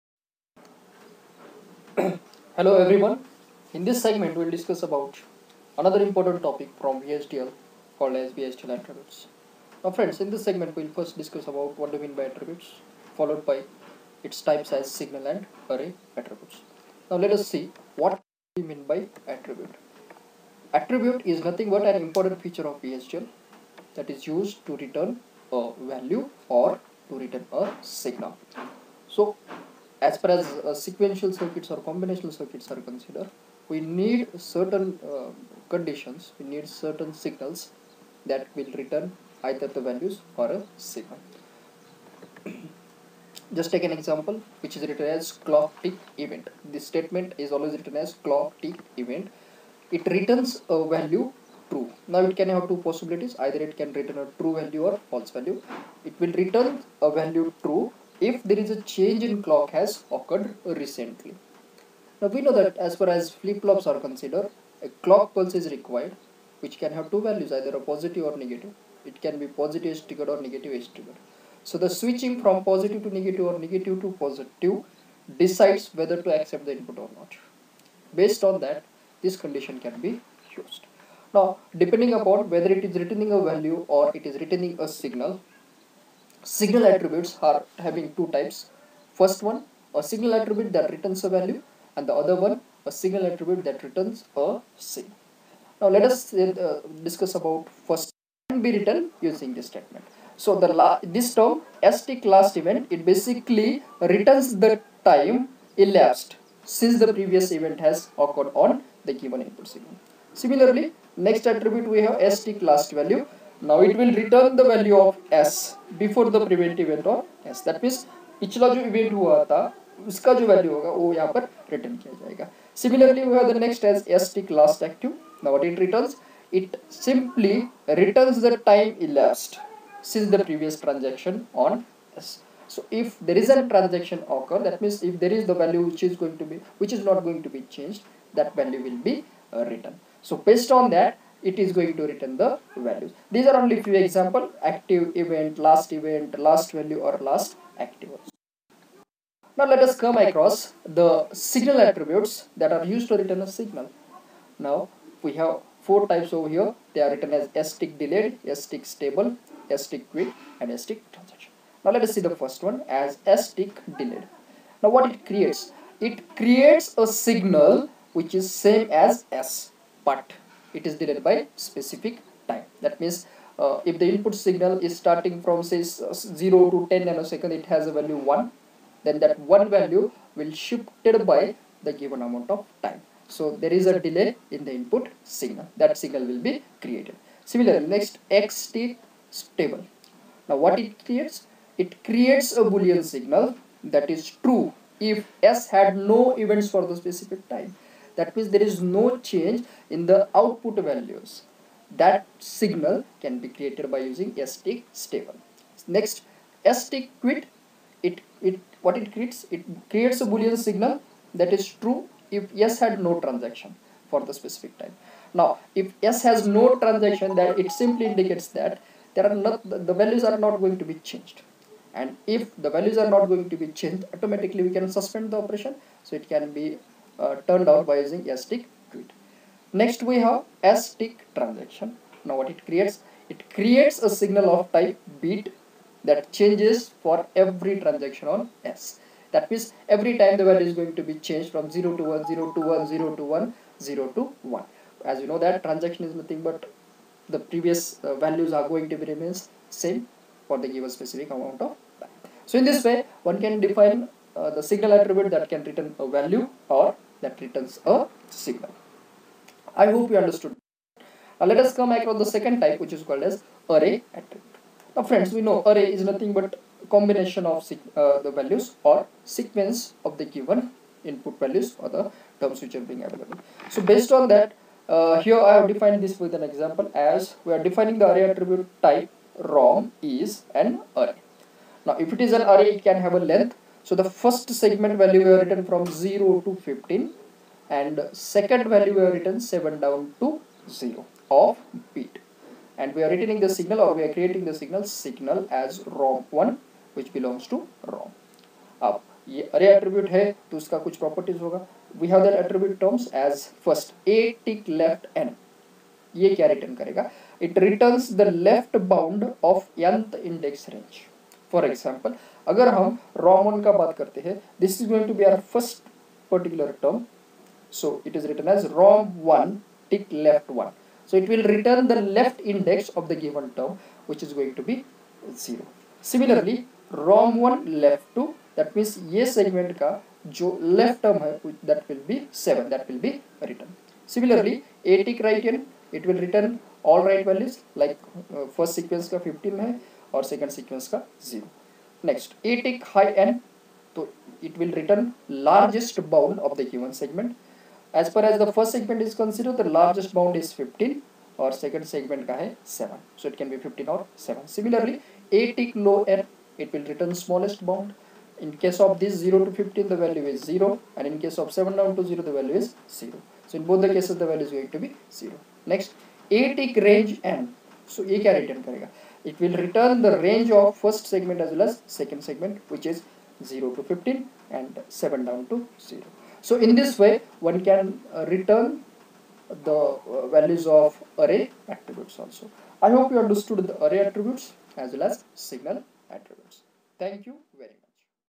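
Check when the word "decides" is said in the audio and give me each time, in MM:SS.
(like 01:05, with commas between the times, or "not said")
01:15.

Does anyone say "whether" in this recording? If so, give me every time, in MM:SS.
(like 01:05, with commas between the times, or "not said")
01:15, 01:22.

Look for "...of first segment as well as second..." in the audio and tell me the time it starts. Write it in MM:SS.
06:10.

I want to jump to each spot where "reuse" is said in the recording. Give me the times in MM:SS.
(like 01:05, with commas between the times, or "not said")
not said.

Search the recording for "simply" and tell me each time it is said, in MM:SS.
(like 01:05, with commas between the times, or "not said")
02:06, 03:37.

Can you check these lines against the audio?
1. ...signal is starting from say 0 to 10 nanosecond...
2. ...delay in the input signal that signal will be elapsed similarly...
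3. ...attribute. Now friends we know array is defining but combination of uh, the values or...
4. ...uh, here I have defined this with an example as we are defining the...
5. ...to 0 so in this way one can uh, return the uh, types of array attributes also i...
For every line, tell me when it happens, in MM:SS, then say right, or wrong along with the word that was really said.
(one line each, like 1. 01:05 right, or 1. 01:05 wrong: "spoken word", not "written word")
1. 02:54 right
2. 03:04 wrong: "created", not "elapsed"
3. 04:24 wrong: "nothing", not "defining"
4. 04:34 right
5. 06:15 wrong: "values", not "types".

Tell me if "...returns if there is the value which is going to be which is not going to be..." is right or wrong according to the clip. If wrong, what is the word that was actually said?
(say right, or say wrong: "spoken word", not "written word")
wrong: "means", not "returns".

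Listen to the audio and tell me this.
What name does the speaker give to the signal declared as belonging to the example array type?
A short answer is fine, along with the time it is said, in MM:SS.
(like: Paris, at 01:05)
ROM1, at 04:55.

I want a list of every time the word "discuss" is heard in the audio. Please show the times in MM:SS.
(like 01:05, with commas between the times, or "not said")
00:04, 00:11, 01:37.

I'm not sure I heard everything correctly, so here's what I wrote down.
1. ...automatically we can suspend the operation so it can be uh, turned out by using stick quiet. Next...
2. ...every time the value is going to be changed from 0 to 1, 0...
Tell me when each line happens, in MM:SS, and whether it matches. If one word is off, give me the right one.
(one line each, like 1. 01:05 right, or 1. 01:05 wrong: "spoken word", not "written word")
1. 03:44 right
2. 03:59 right.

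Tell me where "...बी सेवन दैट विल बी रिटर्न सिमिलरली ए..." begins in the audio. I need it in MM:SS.
05:32.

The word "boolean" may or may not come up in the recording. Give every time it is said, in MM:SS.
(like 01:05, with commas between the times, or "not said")
03:12, 03:30.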